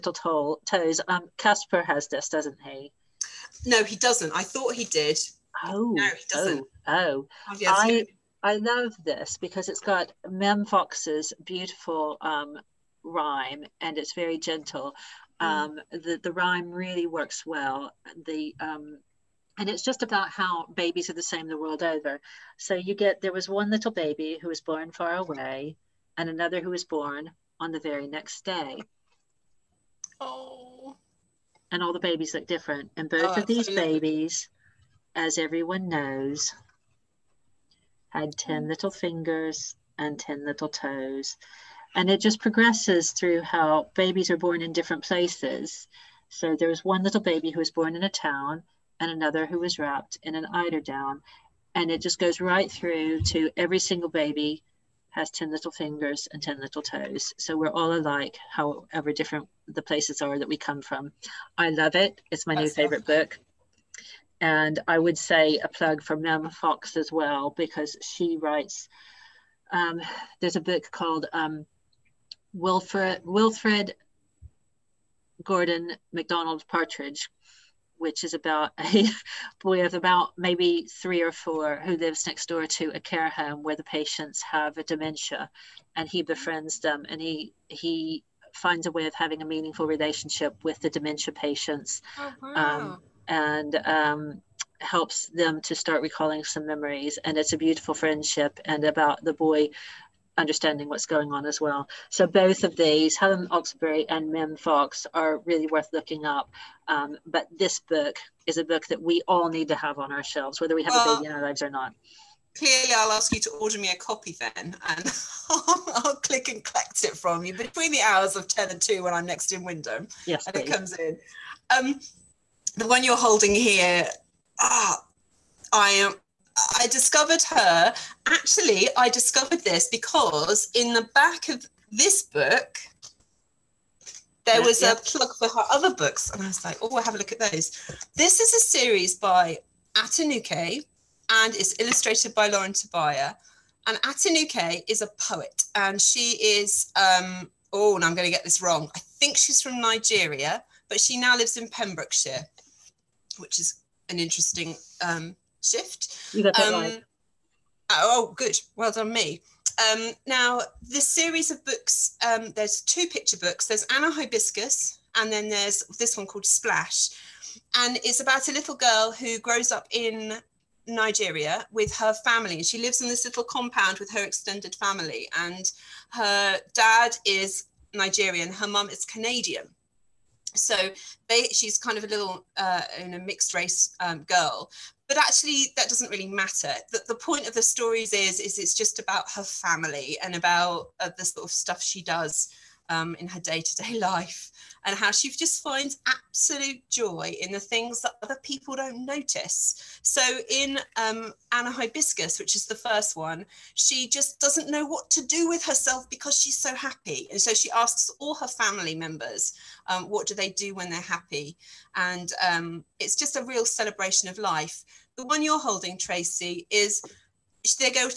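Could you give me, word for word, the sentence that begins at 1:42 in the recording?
So both of these, Helen Oxenbury and Mem Fox, are really worth looking up.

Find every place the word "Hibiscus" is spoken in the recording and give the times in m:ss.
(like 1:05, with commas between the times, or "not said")
2:44, 3:21.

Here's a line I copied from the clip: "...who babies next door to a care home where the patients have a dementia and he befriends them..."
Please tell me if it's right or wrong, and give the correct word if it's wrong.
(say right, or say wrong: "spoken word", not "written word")
wrong: "lives", not "babies".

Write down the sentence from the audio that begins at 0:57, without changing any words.
So we're all alike, however different the places are that we come from.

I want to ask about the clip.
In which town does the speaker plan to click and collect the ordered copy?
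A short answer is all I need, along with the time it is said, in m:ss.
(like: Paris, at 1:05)
Wymondham, at 1:59.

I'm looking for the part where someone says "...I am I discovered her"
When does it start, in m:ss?
2:05.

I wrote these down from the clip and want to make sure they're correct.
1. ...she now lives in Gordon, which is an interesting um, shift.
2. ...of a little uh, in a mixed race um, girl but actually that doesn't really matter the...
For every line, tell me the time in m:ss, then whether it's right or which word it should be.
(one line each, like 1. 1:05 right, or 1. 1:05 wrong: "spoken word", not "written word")
1. 2:30 wrong: "Pembrokeshire", not "Gordon"
2. 3:01 right.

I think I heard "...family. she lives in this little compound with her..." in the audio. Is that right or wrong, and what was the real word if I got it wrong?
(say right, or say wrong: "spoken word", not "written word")
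right.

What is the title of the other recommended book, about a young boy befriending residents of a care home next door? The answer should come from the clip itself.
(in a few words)
Wilfrid Gordon McDonald Partridge.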